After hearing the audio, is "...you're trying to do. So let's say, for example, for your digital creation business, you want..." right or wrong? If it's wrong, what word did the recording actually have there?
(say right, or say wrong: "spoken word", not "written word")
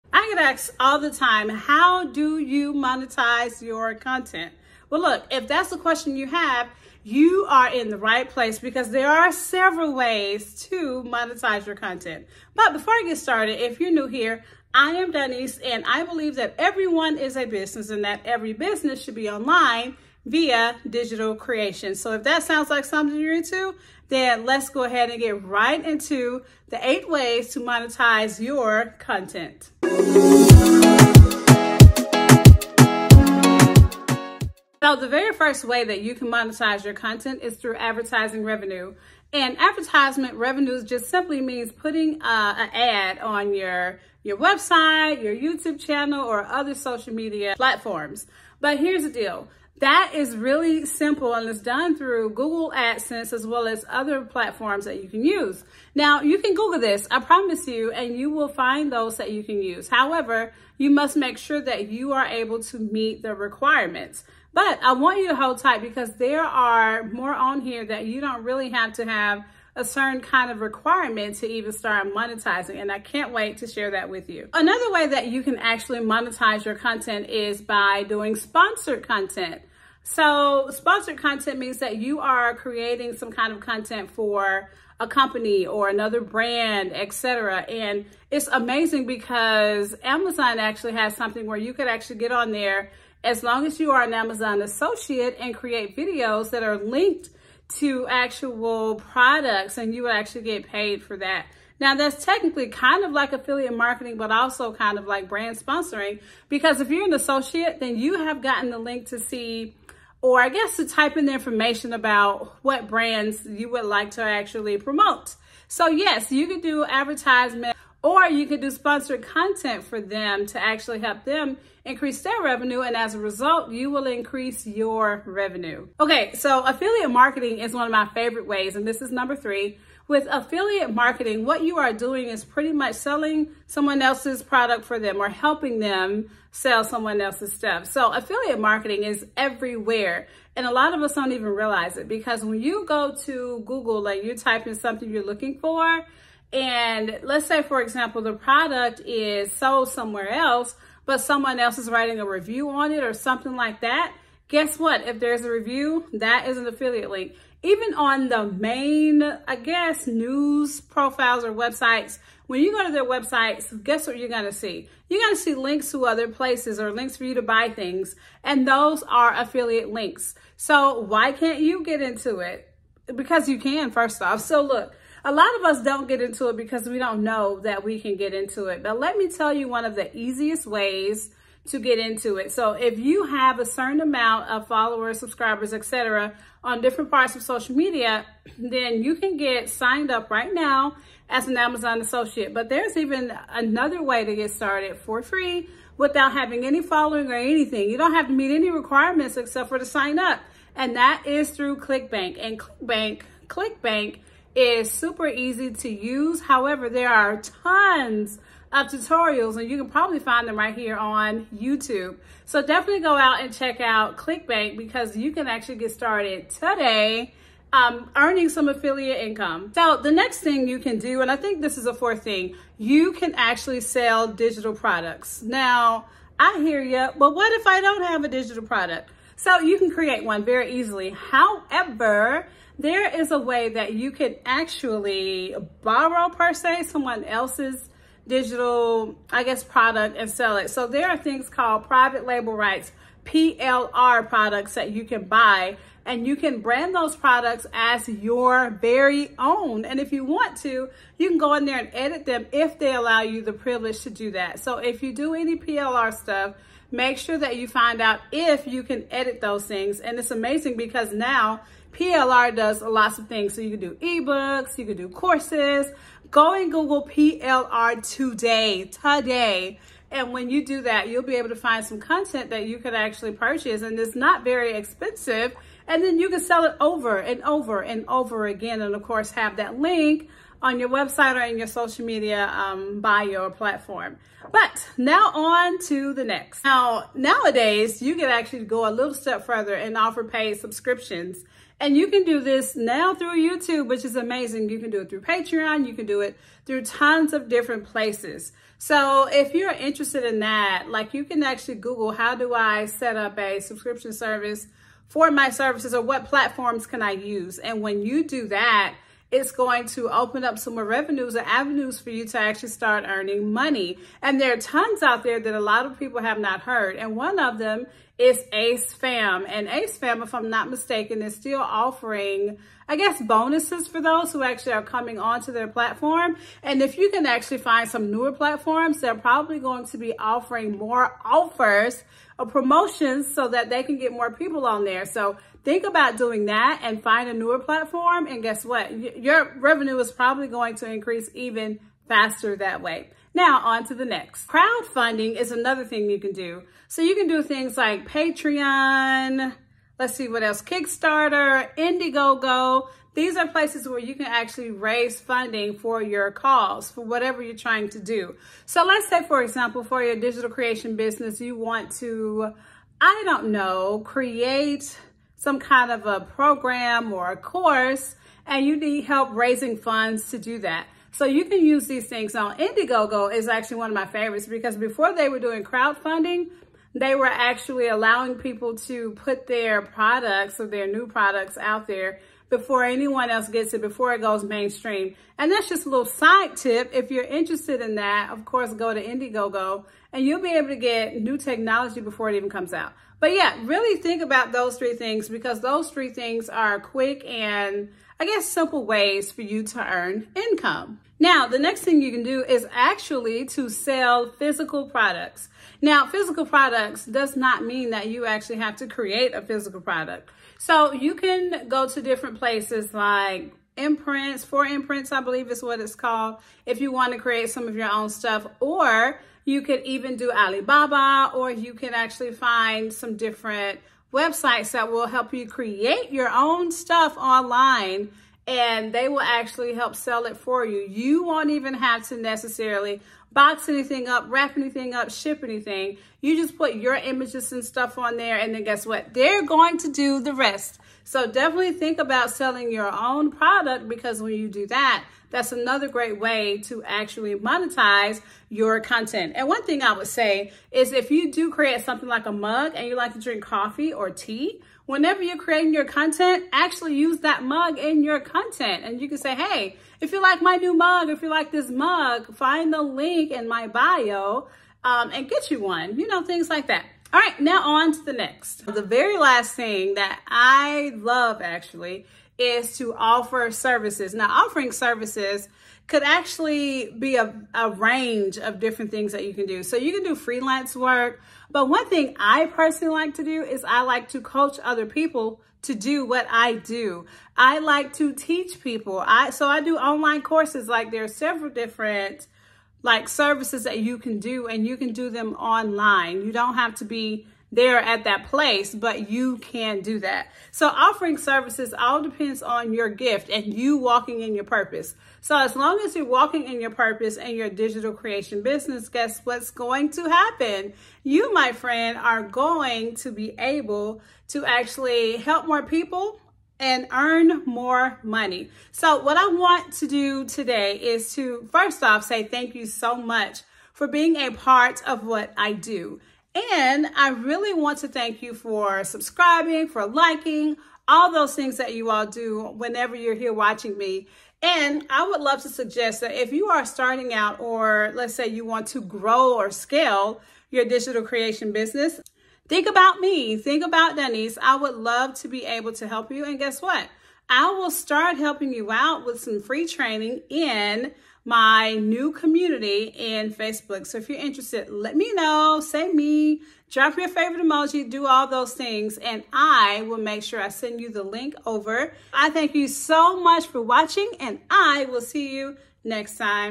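right.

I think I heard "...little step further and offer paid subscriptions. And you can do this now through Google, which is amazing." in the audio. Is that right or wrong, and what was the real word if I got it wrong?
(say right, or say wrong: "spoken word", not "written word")
wrong: "YouTube", not "Google".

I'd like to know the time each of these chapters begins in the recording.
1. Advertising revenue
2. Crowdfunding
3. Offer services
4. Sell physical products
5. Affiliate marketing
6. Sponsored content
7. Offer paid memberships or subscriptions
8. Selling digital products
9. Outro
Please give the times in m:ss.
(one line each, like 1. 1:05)
1. 0:37
2. 5:44
3. 7:48
4. 6:42
5. 2:07
6. 1:16
7. 4:47
8. 3:40
9. 8:31.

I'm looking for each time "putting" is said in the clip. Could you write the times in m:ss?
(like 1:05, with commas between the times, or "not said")
0:41.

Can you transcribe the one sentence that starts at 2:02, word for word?
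And as a result, you will increase your revenue.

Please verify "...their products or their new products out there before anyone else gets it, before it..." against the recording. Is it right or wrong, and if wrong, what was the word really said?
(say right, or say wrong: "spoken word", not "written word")
right.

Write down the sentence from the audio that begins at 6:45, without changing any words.
Now, physical products does not mean that you actually have to create a physical product.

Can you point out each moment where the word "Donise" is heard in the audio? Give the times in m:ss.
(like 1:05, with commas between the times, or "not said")
0:15, 9:03.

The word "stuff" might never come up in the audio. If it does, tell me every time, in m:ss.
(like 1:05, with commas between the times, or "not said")
2:17, 4:16, 6:58, 7:06, 7:17.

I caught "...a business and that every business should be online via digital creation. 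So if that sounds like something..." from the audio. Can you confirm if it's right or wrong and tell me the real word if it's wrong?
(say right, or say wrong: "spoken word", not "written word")
right.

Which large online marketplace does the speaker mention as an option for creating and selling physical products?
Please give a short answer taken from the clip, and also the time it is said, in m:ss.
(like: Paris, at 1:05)
Alibaba, at 7:00.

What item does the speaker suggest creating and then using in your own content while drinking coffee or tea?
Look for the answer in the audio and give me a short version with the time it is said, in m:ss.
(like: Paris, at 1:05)
A mug, at 7:32.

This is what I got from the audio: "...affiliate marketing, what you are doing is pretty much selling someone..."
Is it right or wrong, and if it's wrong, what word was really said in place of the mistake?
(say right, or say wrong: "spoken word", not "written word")
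right.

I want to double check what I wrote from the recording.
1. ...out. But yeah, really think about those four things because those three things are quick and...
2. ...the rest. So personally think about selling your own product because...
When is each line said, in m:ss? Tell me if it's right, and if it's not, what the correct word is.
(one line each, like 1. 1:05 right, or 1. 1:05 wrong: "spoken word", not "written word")
1. 6:32 wrong: "three", not "four"
2. 7:20 wrong: "definitely", not "personally".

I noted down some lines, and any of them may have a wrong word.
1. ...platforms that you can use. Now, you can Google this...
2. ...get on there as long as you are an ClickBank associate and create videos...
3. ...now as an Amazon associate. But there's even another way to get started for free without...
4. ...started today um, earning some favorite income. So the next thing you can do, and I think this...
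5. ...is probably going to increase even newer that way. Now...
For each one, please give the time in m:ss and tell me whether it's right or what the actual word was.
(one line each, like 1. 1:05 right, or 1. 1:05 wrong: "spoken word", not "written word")
1. 0:54 right
2. 1:32 wrong: "Amazon", not "ClickBank"
3. 3:10 right
4. 3:35 wrong: "affiliate", not "favorite"
5. 5:39 wrong: "faster", not "newer".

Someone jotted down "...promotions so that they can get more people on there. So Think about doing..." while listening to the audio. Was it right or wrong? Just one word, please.
right.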